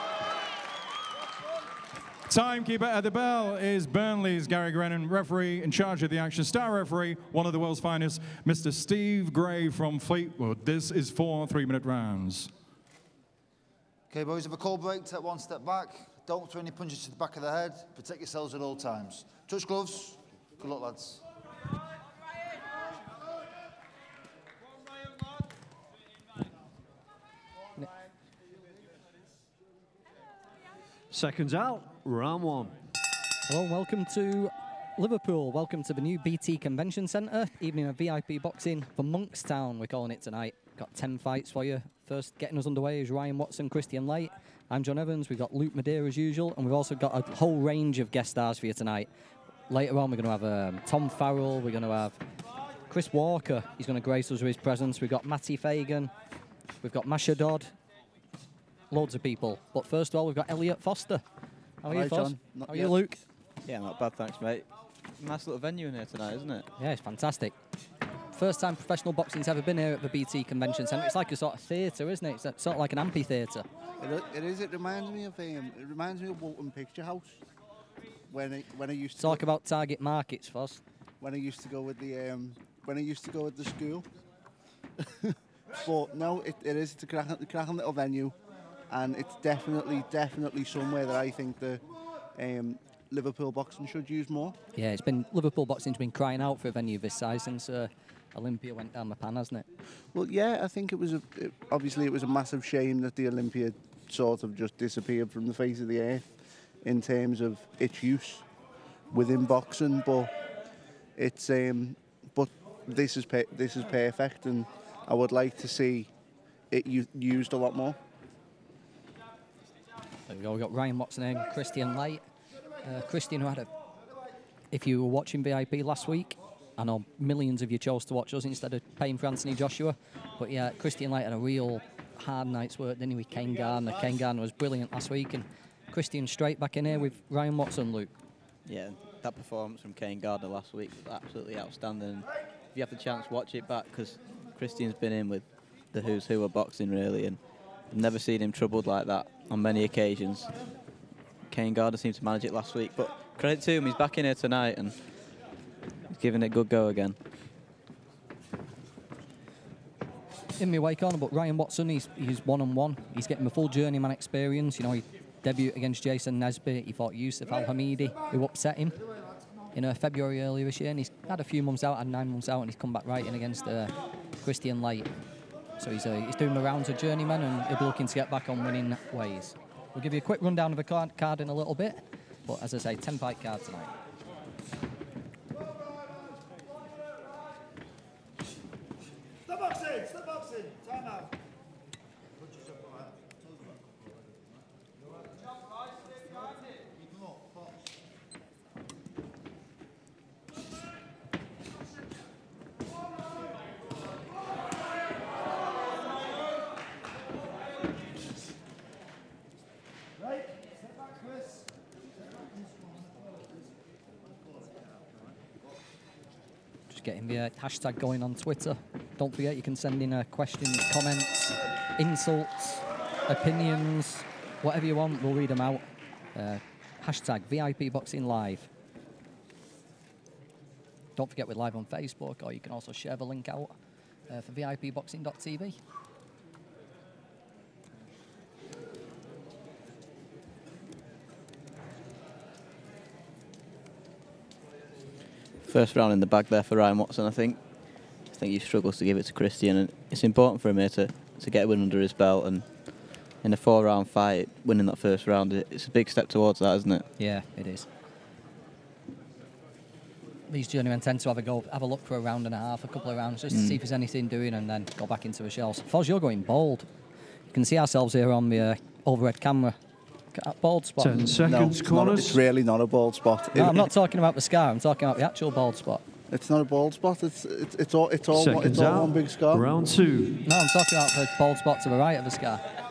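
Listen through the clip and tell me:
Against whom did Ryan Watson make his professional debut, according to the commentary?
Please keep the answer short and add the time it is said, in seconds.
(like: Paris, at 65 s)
Jason Nesbitt, at 166 s.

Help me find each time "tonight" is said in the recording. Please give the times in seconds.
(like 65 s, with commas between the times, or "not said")
40 s, 48 s, 66 s, 154 s, 183 s.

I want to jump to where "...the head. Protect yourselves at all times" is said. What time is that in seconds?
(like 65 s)
17 s.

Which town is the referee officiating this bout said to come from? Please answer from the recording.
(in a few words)
Fleetwood.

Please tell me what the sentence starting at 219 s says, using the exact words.
Don't forget, you can send in uh, questions, comments, insults, opinions, whatever you want.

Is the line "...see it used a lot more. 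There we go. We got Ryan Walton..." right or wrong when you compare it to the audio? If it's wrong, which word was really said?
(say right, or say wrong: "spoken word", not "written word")
wrong: "Watson", not "Walton".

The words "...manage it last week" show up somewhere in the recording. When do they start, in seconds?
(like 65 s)
152 s.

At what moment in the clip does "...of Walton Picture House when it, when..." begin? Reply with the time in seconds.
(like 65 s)
76 s.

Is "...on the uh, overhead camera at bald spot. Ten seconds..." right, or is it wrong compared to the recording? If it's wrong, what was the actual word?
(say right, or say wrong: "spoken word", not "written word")
right.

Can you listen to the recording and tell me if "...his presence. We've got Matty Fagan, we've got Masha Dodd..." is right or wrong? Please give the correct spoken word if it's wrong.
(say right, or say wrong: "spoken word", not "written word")
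right.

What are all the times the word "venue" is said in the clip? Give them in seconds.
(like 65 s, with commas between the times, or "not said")
65 s, 87 s, 96 s.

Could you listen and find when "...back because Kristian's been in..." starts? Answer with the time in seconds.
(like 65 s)
143 s.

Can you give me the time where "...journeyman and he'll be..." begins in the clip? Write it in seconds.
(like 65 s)
176 s.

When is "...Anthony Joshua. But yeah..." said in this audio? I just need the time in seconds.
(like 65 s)
129 s.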